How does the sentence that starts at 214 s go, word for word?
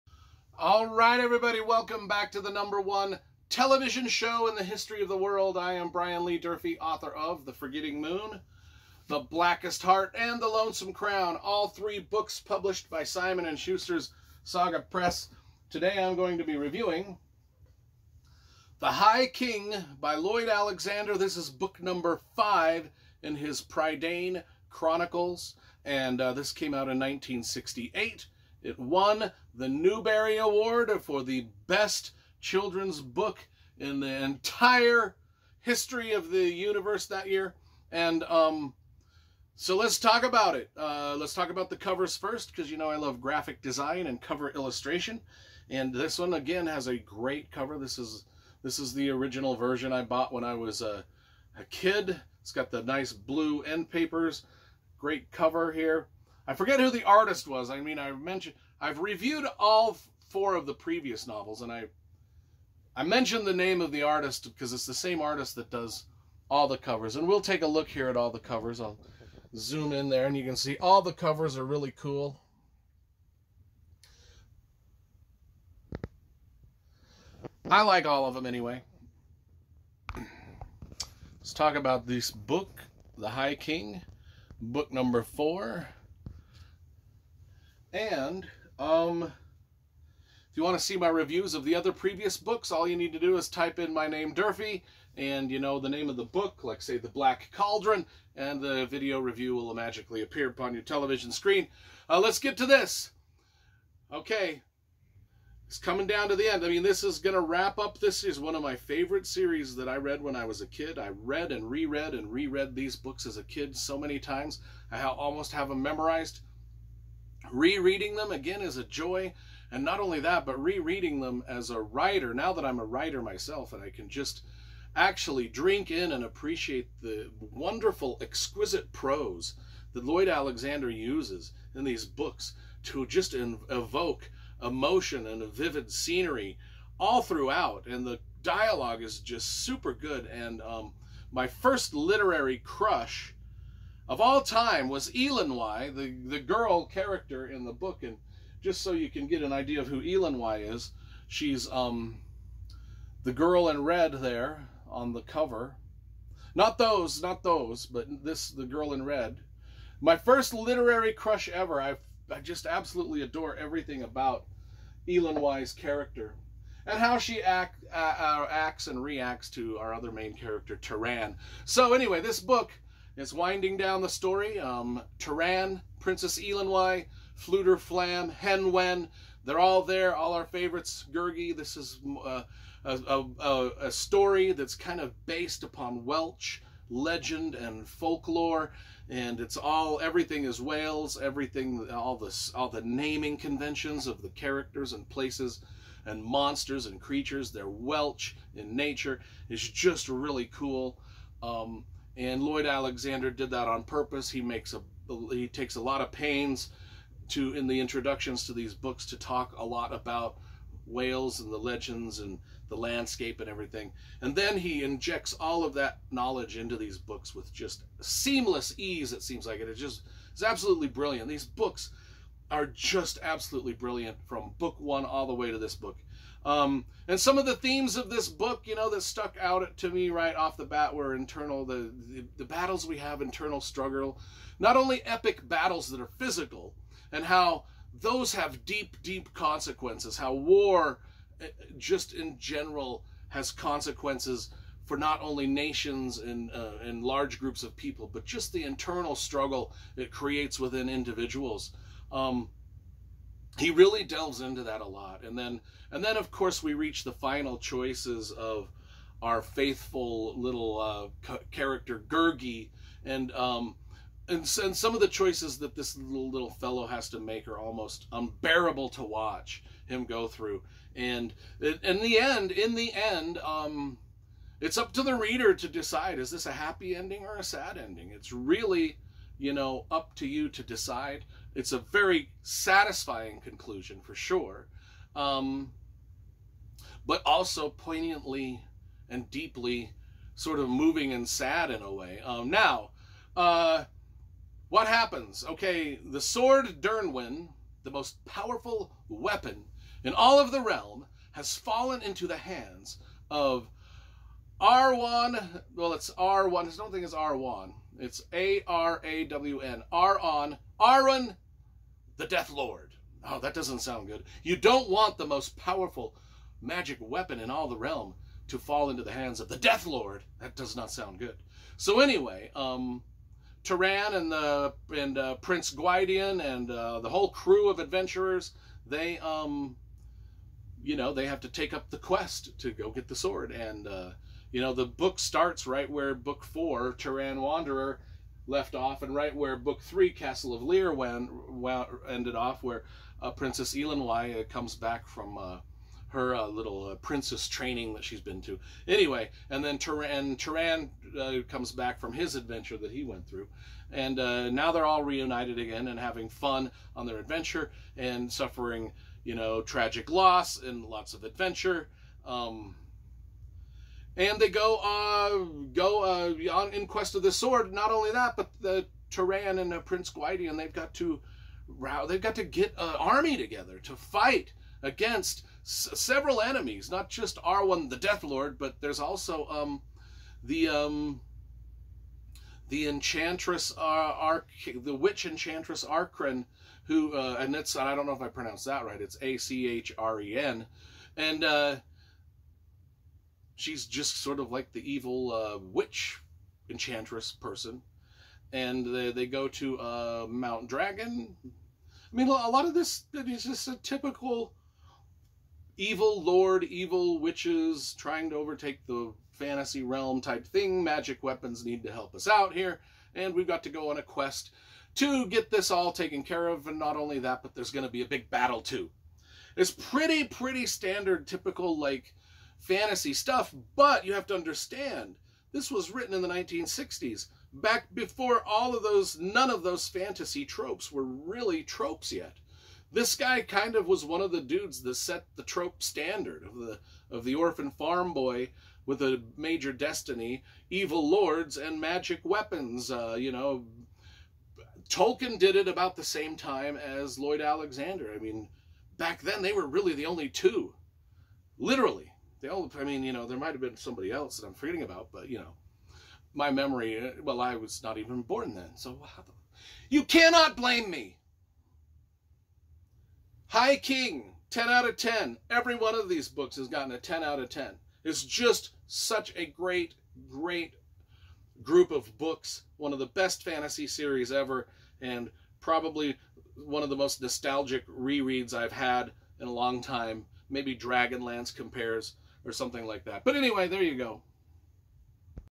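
And then he injects all of that knowledge into these books with just seamless ease, it seems like it.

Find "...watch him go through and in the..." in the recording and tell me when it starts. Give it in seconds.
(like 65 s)
269 s.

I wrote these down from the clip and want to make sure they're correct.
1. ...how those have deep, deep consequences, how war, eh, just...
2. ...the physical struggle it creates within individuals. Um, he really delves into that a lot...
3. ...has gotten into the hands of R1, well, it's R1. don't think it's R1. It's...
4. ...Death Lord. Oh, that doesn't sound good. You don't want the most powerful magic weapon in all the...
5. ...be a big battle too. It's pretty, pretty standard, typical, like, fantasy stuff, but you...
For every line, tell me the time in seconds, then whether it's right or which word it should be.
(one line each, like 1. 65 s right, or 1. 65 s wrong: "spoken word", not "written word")
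1. 237 s right
2. 248 s wrong: "internal", not "physical"
3. 301 s wrong: "fallen", not "gotten"
4. 312 s right
5. 417 s right.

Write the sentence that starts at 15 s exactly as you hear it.
Today I'm going to be reviewing The High King by Lloyd Alexander.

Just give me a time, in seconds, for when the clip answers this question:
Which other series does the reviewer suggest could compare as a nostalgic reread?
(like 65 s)
480 s.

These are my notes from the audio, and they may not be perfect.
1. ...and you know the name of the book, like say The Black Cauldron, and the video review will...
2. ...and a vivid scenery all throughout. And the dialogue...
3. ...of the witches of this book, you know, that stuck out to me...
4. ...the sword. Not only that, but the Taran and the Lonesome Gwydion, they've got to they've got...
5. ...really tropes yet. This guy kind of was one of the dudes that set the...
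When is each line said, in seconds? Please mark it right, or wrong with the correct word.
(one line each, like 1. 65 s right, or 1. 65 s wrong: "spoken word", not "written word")
1. 95 s right
2. 135 s right
3. 227 s wrong: "themes", not "witches"
4. 367 s wrong: "Prince", not "Lonesome"
5. 431 s right.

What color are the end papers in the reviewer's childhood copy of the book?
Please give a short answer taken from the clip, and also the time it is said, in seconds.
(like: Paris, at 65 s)
Blue, at 53 s.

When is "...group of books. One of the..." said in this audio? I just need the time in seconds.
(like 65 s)
471 s.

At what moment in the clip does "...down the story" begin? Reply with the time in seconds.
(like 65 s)
173 s.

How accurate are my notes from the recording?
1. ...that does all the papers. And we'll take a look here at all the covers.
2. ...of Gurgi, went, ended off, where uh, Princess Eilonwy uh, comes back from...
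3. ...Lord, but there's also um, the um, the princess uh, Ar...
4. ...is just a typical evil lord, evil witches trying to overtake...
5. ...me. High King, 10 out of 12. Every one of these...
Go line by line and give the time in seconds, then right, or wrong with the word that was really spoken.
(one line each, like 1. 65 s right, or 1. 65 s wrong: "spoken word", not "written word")
1. 65 s wrong: "covers", not "papers"
2. 340 s wrong: "Llyr", not "Gurgi"
3. 378 s wrong: "enchantress", not "princess"
4. 403 s right
5. 460 s wrong: "10", not "12".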